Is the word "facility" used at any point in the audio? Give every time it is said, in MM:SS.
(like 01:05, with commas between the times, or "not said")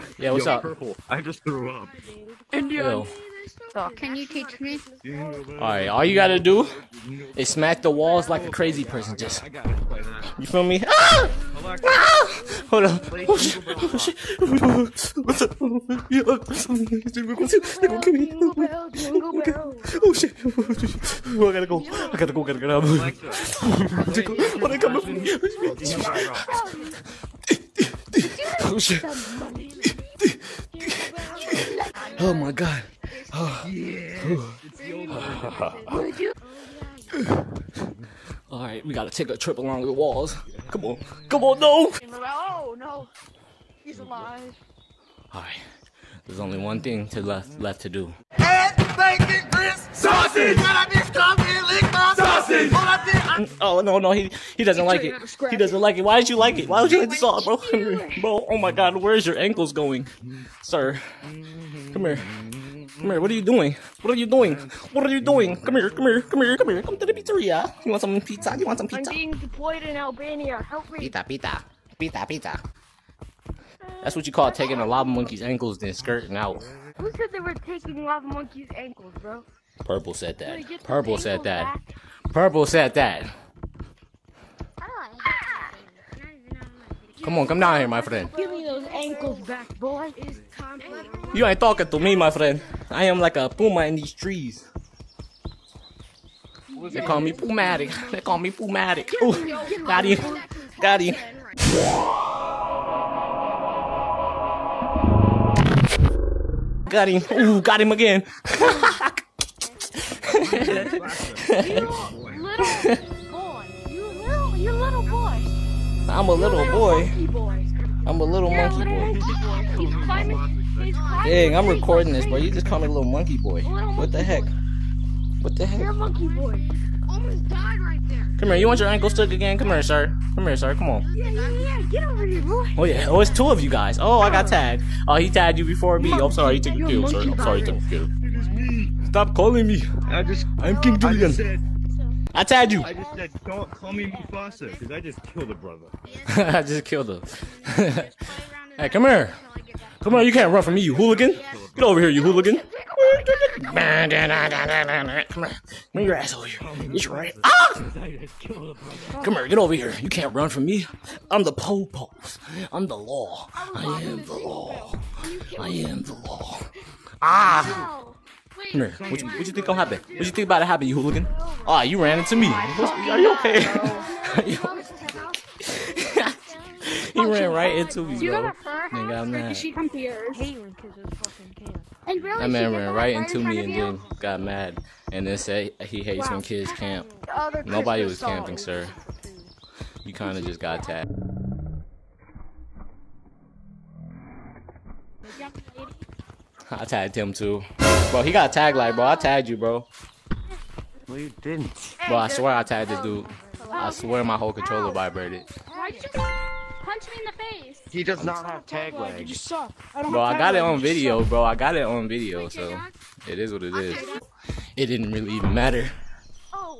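not said.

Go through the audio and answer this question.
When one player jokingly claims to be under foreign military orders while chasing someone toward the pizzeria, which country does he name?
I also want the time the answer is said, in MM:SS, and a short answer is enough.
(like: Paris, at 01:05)
Albania, at 01:09.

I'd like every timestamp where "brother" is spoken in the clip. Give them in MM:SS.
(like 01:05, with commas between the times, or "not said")
02:25.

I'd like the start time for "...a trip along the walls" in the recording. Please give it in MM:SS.
00:39.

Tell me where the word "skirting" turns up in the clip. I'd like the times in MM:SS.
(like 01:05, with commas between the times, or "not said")
01:15.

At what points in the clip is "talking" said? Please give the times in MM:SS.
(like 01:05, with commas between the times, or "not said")
01:31.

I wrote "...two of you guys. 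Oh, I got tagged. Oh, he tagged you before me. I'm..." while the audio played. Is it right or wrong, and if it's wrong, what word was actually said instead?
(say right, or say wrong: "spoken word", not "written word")
right.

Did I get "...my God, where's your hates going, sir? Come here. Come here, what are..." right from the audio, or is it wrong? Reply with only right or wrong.
wrong.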